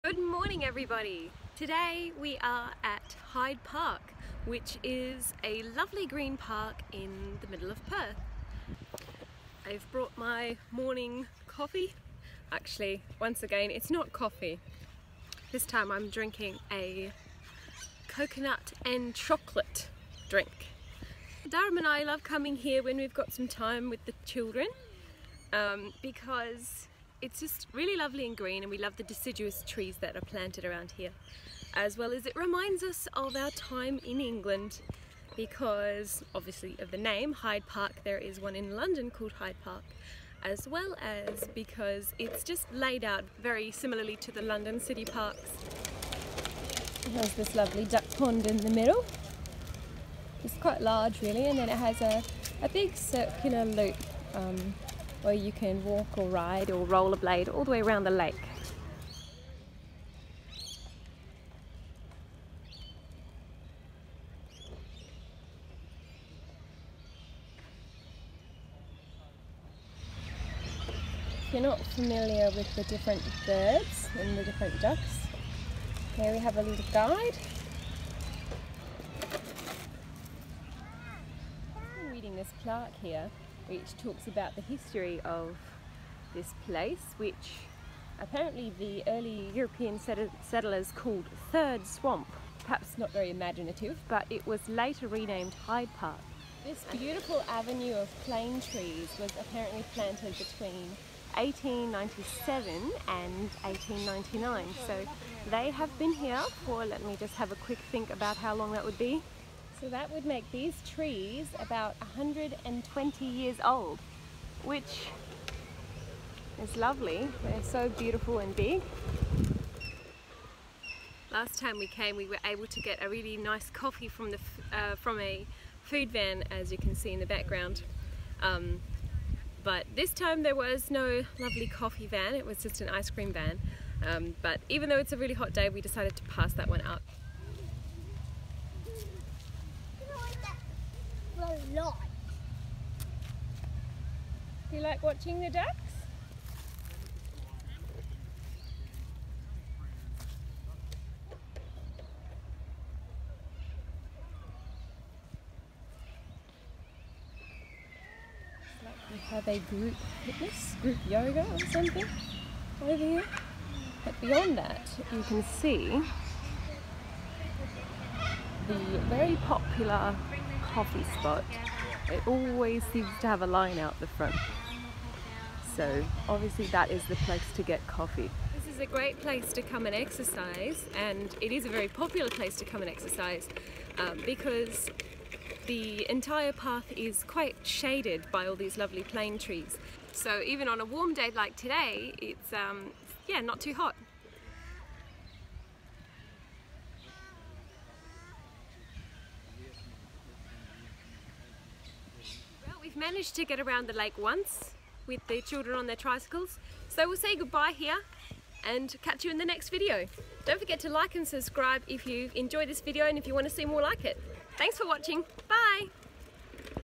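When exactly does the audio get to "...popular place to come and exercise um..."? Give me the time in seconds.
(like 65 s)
181 s.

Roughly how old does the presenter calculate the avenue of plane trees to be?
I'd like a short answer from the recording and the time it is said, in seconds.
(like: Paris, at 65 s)
120 years, at 112 s.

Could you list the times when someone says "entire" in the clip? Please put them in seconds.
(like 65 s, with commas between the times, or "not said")
186 s.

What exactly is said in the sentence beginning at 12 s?
Actually once again it's not coffee.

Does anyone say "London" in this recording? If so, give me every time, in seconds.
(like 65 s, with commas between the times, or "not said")
38 s, 44 s.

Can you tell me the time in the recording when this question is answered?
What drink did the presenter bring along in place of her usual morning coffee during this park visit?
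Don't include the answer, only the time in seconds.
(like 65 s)
18 s.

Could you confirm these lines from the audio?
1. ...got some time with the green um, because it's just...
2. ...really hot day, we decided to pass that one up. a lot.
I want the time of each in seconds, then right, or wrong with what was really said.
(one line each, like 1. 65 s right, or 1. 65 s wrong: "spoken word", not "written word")
1. 23 s wrong: "children", not "green"
2. 135 s right.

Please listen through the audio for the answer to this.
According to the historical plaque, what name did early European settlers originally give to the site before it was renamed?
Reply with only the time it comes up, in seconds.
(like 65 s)
91 s.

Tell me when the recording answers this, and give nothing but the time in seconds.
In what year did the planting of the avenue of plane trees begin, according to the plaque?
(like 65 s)
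101 s.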